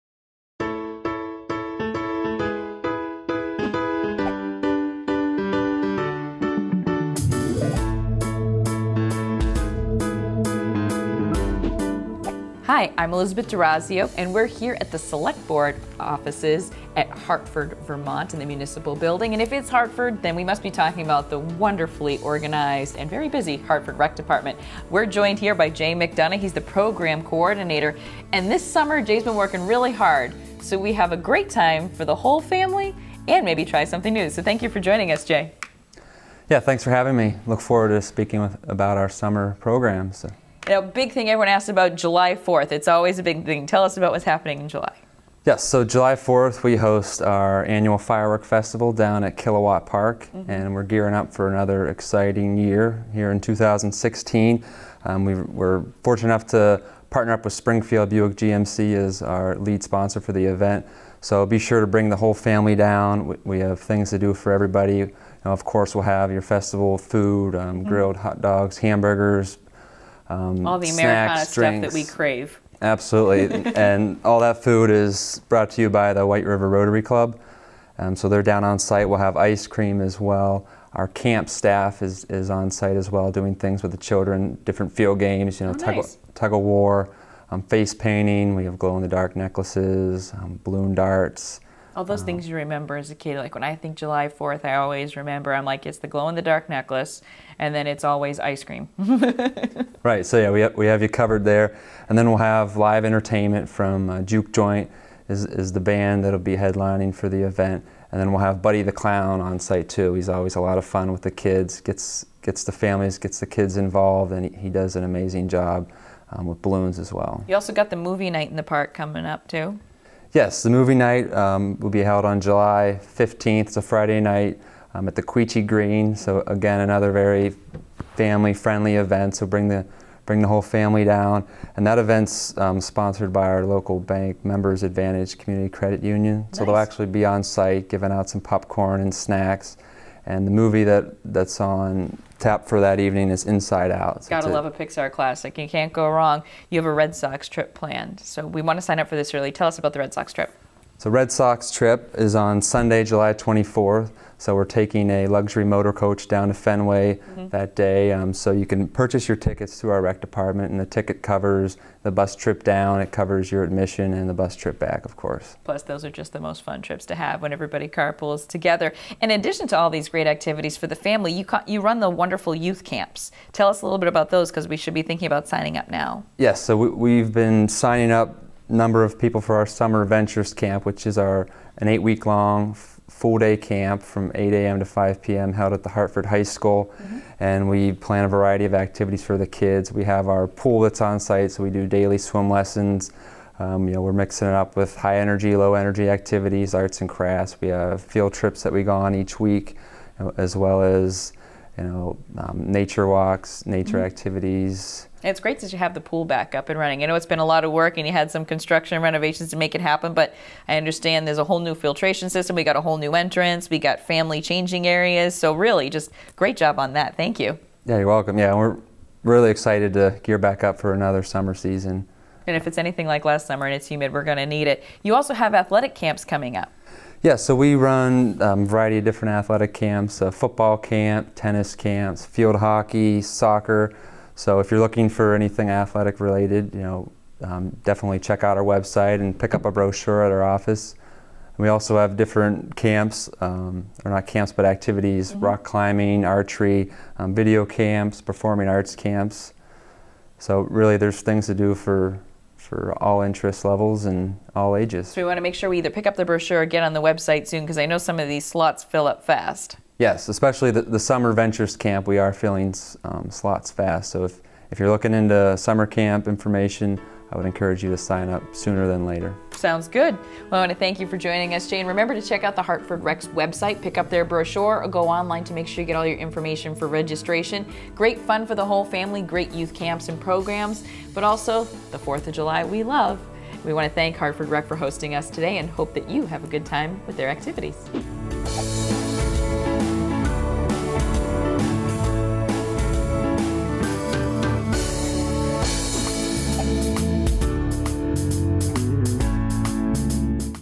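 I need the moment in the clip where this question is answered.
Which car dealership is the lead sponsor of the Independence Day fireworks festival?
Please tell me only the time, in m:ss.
0:57.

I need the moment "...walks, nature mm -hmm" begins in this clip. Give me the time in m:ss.
3:23.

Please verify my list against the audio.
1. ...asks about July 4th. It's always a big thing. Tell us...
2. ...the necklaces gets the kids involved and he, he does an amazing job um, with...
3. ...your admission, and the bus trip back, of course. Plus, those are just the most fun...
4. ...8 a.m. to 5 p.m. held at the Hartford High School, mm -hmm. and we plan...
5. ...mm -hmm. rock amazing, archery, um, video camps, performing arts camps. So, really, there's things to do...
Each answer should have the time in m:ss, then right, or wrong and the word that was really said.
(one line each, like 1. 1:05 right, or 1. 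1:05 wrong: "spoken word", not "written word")
1. 0:41 right
2. 1:52 wrong: "families", not "necklaces"
3. 2:43 right
4. 3:04 right
5. 4:05 wrong: "climbing", not "amazing".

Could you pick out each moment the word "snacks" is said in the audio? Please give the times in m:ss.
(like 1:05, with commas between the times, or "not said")
1:11, 2:19.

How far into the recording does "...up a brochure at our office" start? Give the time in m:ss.
3:59.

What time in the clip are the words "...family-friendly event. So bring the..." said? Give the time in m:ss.
2:08.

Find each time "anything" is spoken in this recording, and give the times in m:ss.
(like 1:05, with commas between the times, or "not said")
3:42, 3:55.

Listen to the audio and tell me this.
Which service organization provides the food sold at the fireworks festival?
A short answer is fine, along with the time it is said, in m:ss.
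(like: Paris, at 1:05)
White River Rotary Club, at 1:16.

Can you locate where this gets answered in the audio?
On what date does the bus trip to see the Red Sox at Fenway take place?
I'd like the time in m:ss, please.
2:33.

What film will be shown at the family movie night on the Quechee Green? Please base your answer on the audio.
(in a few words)
Inside Out.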